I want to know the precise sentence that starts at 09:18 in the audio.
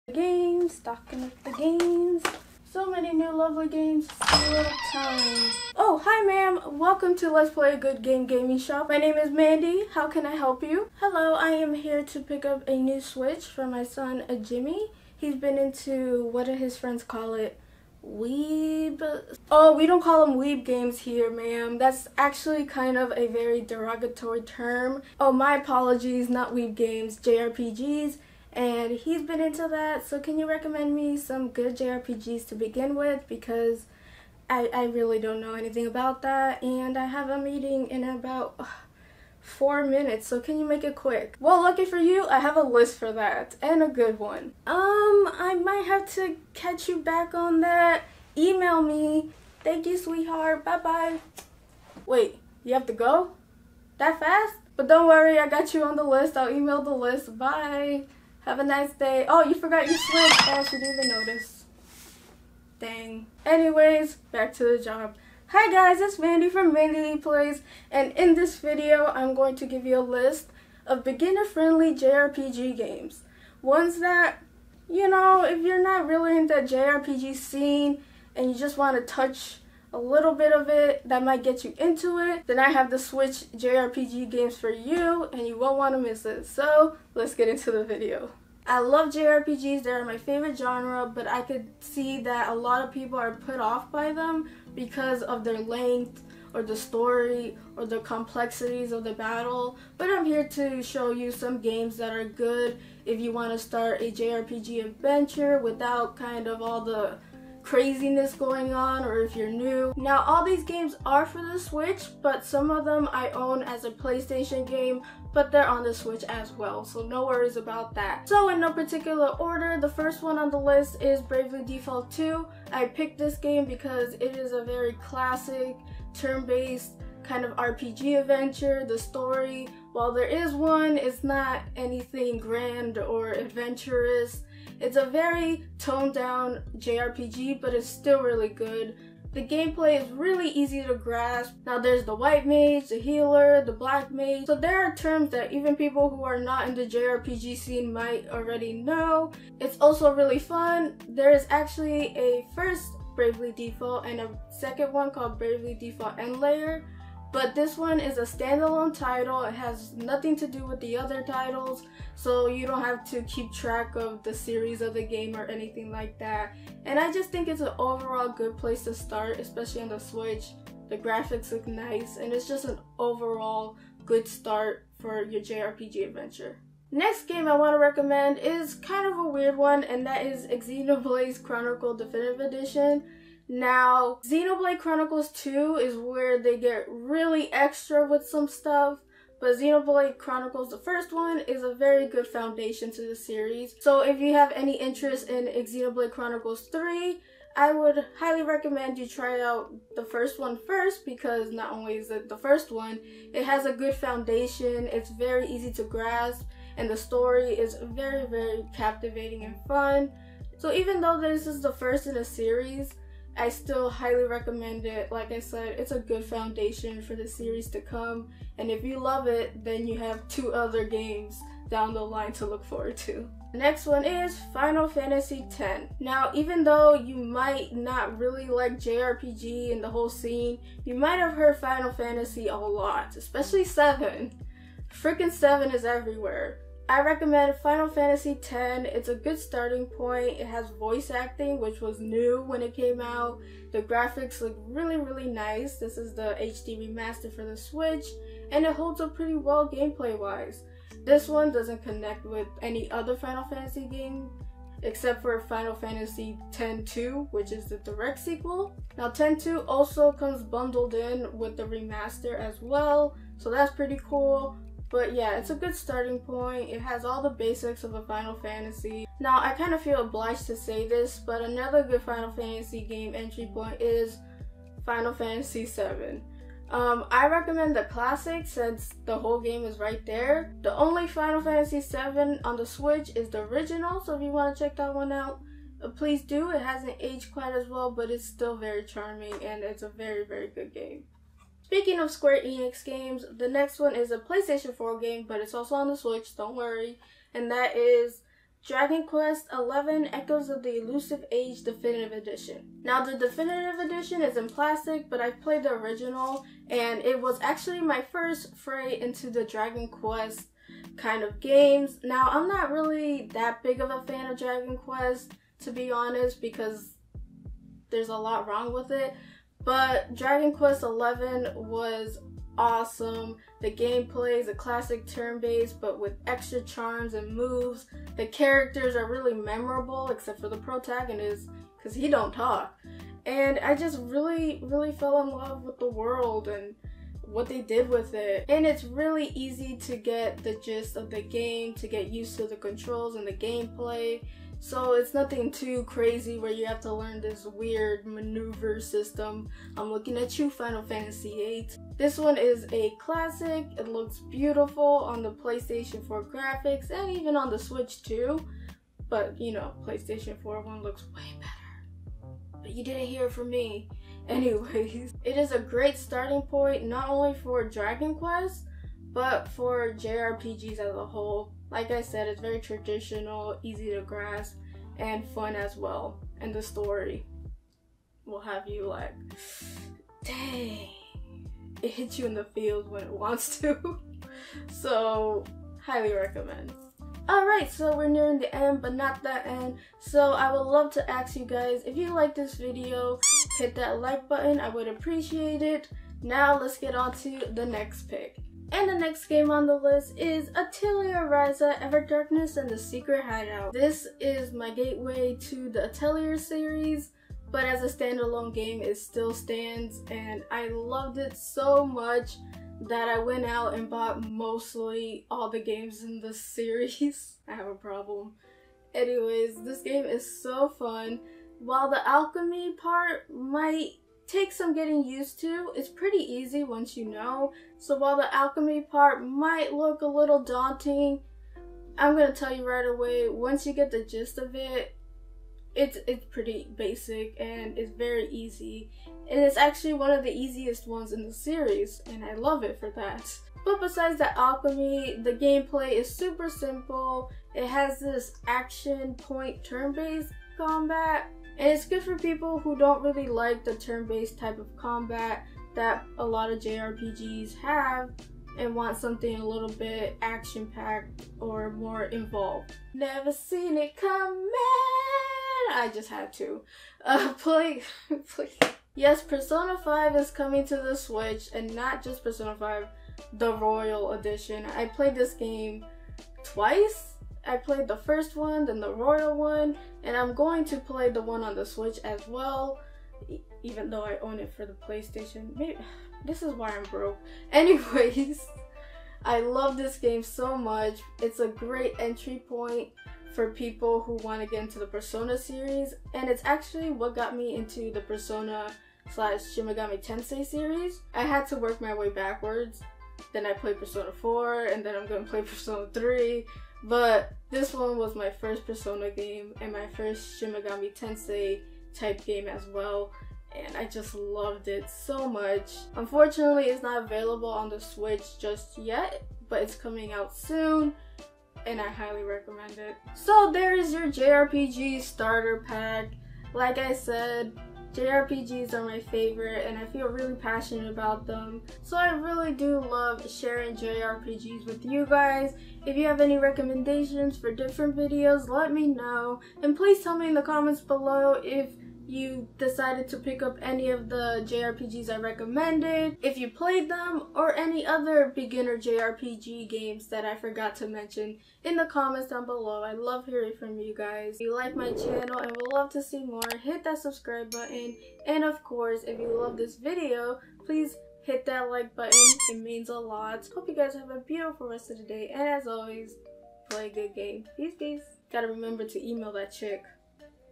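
And of course, if you love this video, please hit that like button.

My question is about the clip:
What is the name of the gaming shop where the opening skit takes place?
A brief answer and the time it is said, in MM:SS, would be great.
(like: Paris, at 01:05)
Let's Play a Good Game Gaming Shop, at 00:07.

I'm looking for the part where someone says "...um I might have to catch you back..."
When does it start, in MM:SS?
00:44.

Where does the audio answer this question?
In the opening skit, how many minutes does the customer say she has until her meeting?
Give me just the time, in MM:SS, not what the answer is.
00:39.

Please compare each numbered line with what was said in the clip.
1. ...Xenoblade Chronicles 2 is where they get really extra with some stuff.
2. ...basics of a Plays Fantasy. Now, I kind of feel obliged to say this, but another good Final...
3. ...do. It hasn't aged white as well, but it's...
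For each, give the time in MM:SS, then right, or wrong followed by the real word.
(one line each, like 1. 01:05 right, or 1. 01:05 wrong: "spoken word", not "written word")
1. 03:04 right
2. 04:27 wrong: "Final", not "Plays"
3. 04:46 wrong: "quite", not "white".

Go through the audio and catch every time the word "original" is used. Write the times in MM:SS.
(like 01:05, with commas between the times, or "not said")
04:43, 05:05.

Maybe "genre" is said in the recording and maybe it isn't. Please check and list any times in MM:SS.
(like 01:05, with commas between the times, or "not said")
01:30.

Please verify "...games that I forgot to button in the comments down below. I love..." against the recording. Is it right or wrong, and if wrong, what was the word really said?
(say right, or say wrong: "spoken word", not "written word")
wrong: "mention", not "button".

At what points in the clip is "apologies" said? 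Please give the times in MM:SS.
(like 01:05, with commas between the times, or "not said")
00:25.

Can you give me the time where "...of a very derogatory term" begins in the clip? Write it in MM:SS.
00:22.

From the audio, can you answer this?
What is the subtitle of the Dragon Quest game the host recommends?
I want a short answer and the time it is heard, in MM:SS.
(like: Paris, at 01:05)
Echoes of the Elusive Age, at 05:00.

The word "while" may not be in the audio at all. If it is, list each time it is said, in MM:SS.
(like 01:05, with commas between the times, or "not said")
02:09, 07:01, 07:07.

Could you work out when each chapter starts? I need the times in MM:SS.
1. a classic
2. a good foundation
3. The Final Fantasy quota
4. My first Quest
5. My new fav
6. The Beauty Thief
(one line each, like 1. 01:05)
1. 02:01
2. 03:00
3. 03:45
4. 05:00
5. 06:40
6. 07:43.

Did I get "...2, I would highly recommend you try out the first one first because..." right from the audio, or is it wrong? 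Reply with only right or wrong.
wrong.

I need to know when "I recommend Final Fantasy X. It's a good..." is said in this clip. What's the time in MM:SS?
03:56.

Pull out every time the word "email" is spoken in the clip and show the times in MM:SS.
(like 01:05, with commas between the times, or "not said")
00:48, 00:56, 09:29.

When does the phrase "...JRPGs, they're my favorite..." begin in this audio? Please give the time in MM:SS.
01:29.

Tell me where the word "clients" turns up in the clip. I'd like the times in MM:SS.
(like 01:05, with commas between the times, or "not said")
not said.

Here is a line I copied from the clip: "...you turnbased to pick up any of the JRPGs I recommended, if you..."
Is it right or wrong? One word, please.
wrong.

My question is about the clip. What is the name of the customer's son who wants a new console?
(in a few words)
Jimmy.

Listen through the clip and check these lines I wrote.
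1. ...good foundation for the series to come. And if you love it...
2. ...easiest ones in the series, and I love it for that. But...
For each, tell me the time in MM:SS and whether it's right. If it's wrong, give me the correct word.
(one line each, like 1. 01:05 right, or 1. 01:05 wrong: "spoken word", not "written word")
1. 03:35 right
2. 07:20 right.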